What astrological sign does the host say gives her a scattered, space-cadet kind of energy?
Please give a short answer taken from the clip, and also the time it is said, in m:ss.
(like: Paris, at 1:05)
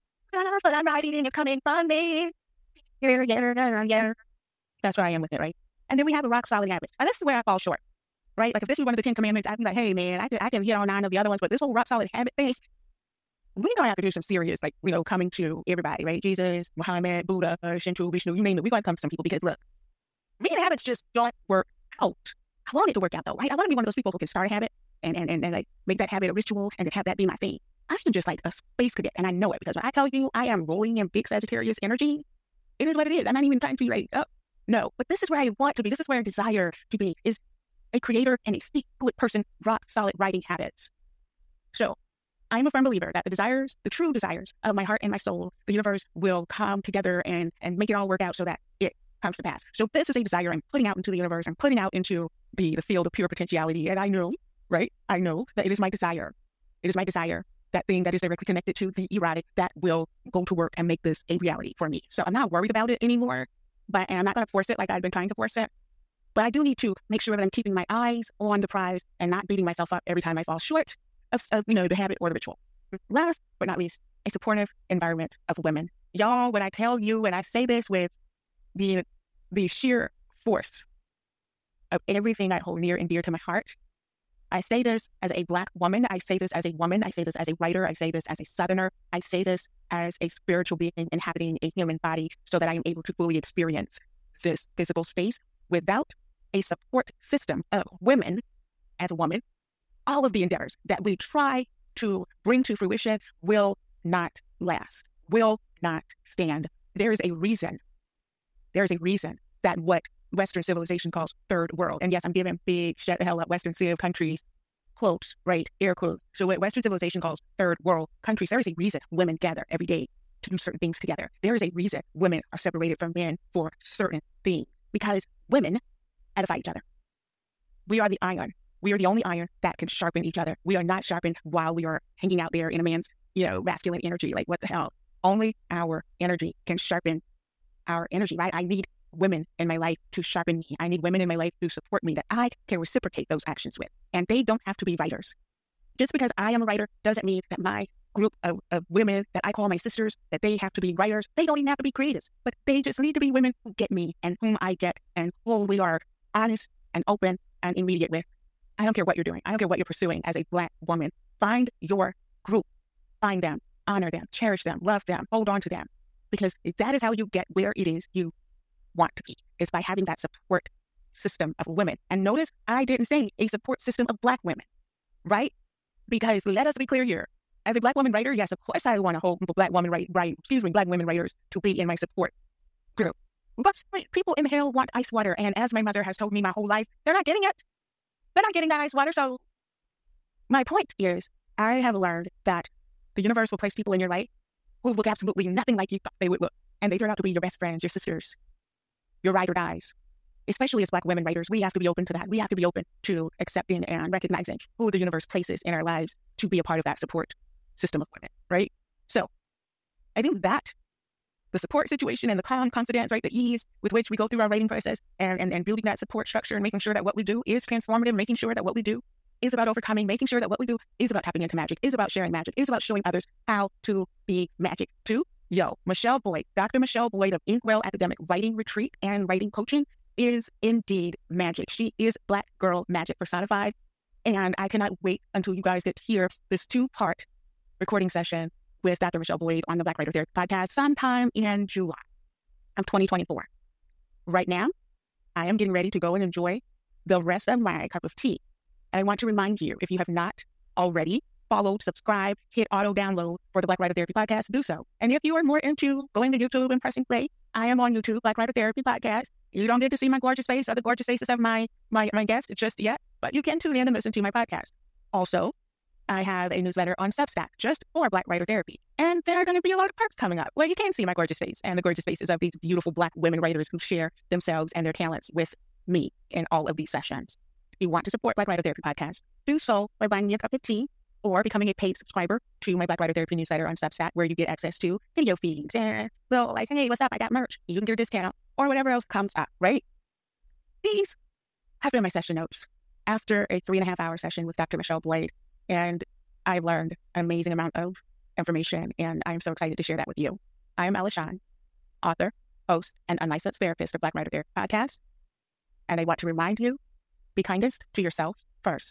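Sagittarius, at 0:31.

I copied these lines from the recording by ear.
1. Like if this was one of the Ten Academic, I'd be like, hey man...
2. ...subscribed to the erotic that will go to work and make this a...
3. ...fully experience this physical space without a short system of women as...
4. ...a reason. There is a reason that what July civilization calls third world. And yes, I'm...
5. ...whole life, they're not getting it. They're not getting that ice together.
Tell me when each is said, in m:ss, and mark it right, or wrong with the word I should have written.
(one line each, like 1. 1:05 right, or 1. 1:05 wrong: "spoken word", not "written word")
1. 0:08 wrong: "Commandments", not "Academic"
2. 0:58 wrong: "connected", not "subscribed"
3. 1:33 wrong: "support", not "short"
4. 1:47 wrong: "Western", not "July"
5. 3:06 wrong: "water", not "together".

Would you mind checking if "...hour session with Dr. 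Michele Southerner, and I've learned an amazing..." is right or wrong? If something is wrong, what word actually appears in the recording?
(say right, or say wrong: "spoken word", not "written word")
wrong: "Boyd", not "Southerner".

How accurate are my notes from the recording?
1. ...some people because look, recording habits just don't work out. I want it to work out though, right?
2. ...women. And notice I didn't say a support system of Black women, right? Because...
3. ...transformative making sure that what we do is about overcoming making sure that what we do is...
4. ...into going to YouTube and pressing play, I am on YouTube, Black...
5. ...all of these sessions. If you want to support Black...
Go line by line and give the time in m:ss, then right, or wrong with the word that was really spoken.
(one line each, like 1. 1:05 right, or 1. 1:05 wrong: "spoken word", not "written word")
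1. 0:18 wrong: "reading", not "recording"
2. 2:51 right
3. 3:37 right
4. 4:15 right
5. 4:36 right.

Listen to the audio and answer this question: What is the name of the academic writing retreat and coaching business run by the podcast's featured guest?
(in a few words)
Inkwell.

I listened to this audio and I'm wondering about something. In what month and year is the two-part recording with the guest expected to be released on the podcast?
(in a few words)
July 2024.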